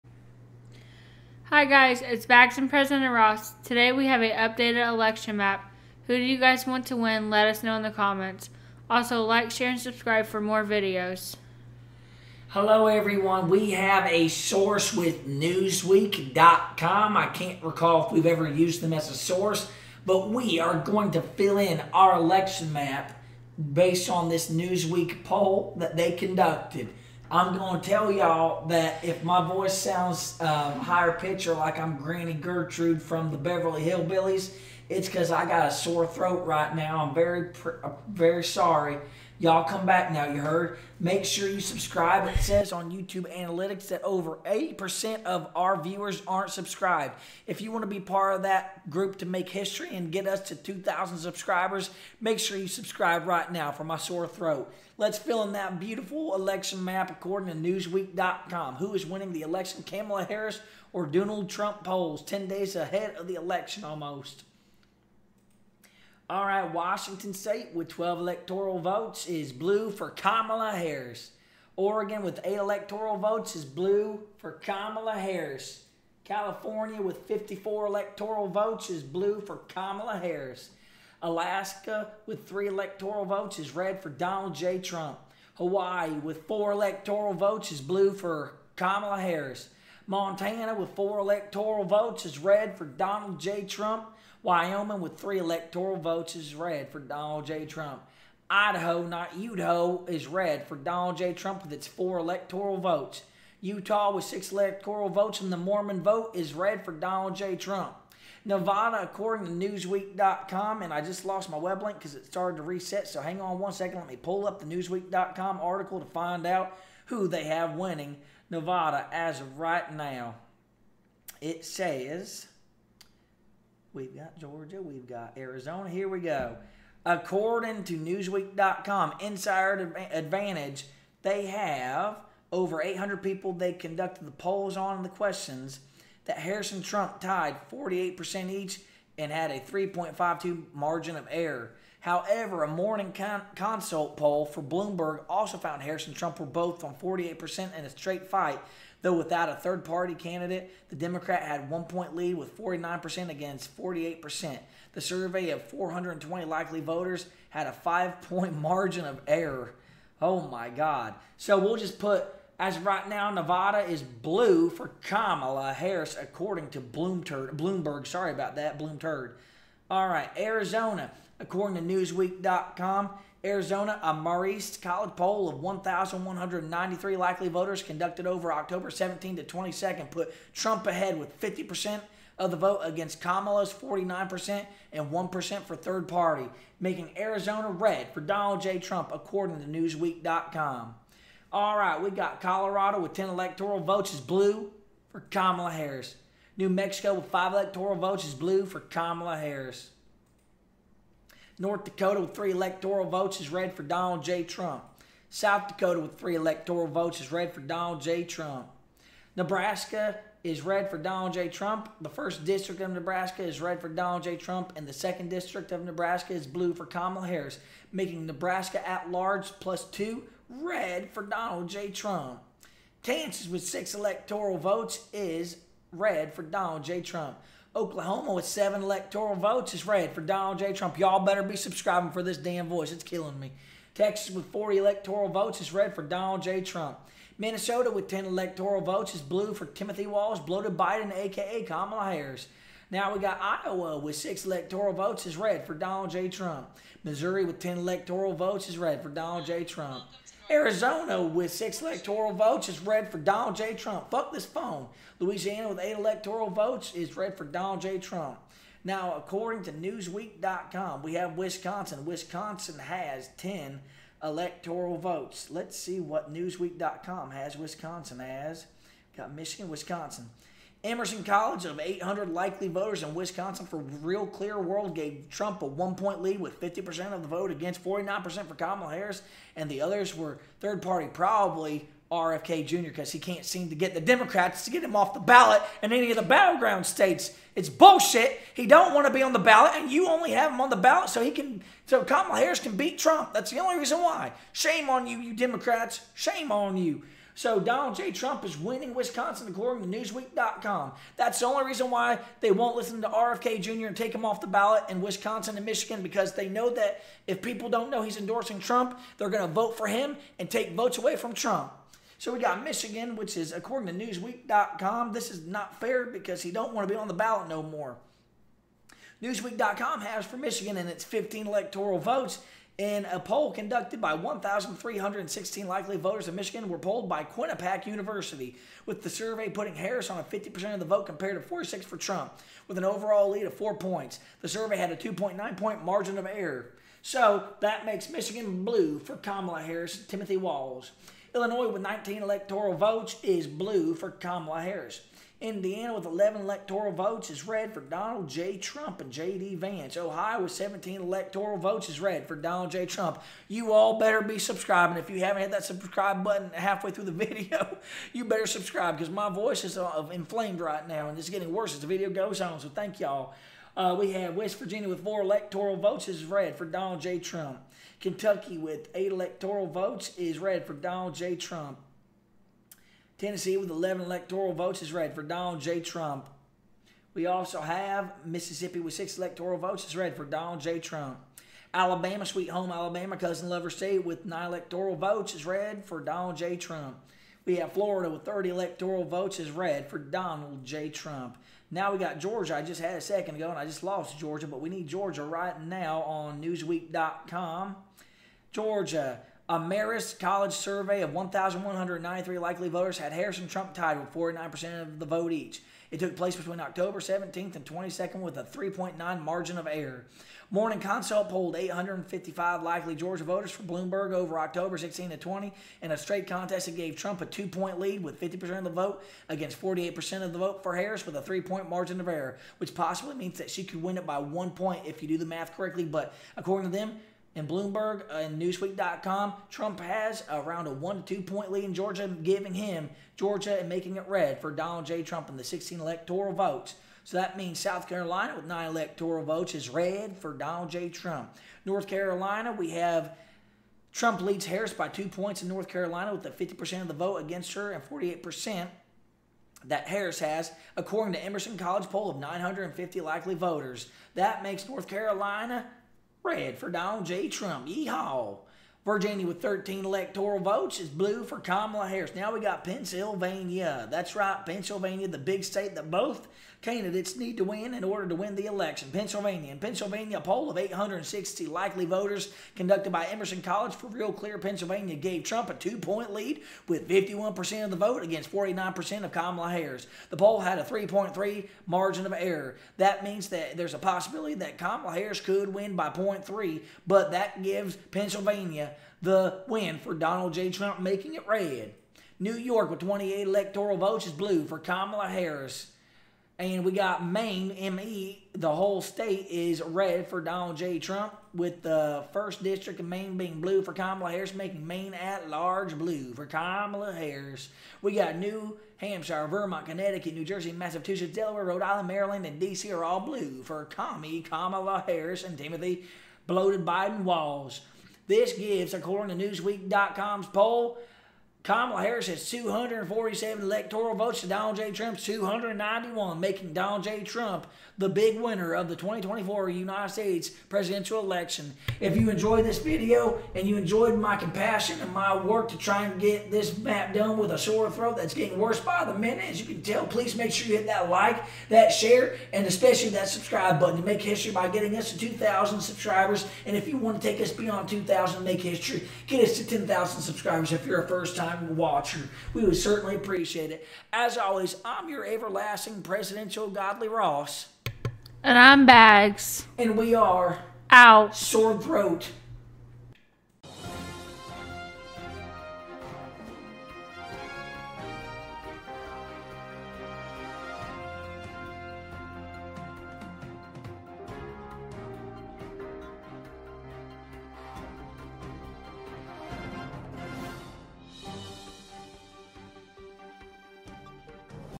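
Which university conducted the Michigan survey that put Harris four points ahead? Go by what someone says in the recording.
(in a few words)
Quinnipiac University.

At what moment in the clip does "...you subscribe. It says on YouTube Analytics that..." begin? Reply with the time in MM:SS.
00:41.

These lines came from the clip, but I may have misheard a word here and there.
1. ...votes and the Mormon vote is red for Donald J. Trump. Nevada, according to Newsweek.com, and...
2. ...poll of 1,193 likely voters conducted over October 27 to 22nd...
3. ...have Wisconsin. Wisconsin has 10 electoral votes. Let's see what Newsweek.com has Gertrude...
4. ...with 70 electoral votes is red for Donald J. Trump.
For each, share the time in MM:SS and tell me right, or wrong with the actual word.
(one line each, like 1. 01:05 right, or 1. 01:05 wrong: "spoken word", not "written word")
1. 01:45 right
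2. 02:55 wrong: "17", not "27"
3. 04:21 wrong: "Wisconsin", not "Gertrude"
4. 06:28 wrong: "30", not "70".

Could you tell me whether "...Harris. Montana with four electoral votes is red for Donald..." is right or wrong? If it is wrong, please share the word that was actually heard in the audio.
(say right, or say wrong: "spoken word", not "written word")
right.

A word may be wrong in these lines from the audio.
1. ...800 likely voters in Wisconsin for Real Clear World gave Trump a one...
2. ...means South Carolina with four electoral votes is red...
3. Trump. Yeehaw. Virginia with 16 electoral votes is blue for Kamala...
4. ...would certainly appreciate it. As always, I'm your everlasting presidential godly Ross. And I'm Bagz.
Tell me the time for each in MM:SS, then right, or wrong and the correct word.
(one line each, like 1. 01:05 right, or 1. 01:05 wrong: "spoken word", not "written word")
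1. 04:31 right
2. 07:17 wrong: "nine", not "four"
3. 07:37 wrong: "13", not "16"
4. 09:12 right.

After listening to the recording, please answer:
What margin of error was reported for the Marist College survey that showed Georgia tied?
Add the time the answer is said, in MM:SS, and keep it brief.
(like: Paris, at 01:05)
3.9, at 06:48.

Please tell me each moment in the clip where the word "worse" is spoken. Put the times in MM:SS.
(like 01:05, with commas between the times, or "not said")
06:01, 08:58.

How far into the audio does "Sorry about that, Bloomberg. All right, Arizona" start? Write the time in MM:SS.
02:48.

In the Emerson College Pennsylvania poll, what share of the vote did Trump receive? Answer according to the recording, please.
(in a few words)
51%.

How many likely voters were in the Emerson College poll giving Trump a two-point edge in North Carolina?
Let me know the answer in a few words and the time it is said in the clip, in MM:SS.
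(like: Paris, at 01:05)
950, at 07:32.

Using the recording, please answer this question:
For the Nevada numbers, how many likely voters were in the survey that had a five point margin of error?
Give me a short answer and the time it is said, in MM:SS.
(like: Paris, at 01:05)
420, at 02:35.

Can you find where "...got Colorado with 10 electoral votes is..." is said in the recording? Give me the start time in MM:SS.
03:12.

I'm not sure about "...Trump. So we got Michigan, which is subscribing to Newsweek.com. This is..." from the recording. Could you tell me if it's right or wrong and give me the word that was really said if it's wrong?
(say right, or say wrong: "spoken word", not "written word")
wrong: "according", not "subscribing".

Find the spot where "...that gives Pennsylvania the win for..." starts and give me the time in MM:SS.
08:07.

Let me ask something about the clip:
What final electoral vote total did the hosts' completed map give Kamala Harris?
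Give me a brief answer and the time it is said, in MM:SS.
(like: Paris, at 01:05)
247, at 08:42.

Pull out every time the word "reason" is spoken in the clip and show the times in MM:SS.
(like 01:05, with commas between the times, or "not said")
04:53, 05:01.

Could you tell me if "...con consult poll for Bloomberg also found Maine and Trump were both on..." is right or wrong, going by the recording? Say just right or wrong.
wrong.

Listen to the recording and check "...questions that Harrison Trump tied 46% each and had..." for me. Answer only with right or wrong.
wrong.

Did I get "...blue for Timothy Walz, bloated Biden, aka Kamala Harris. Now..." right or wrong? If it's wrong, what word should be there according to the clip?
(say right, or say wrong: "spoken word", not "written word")
right.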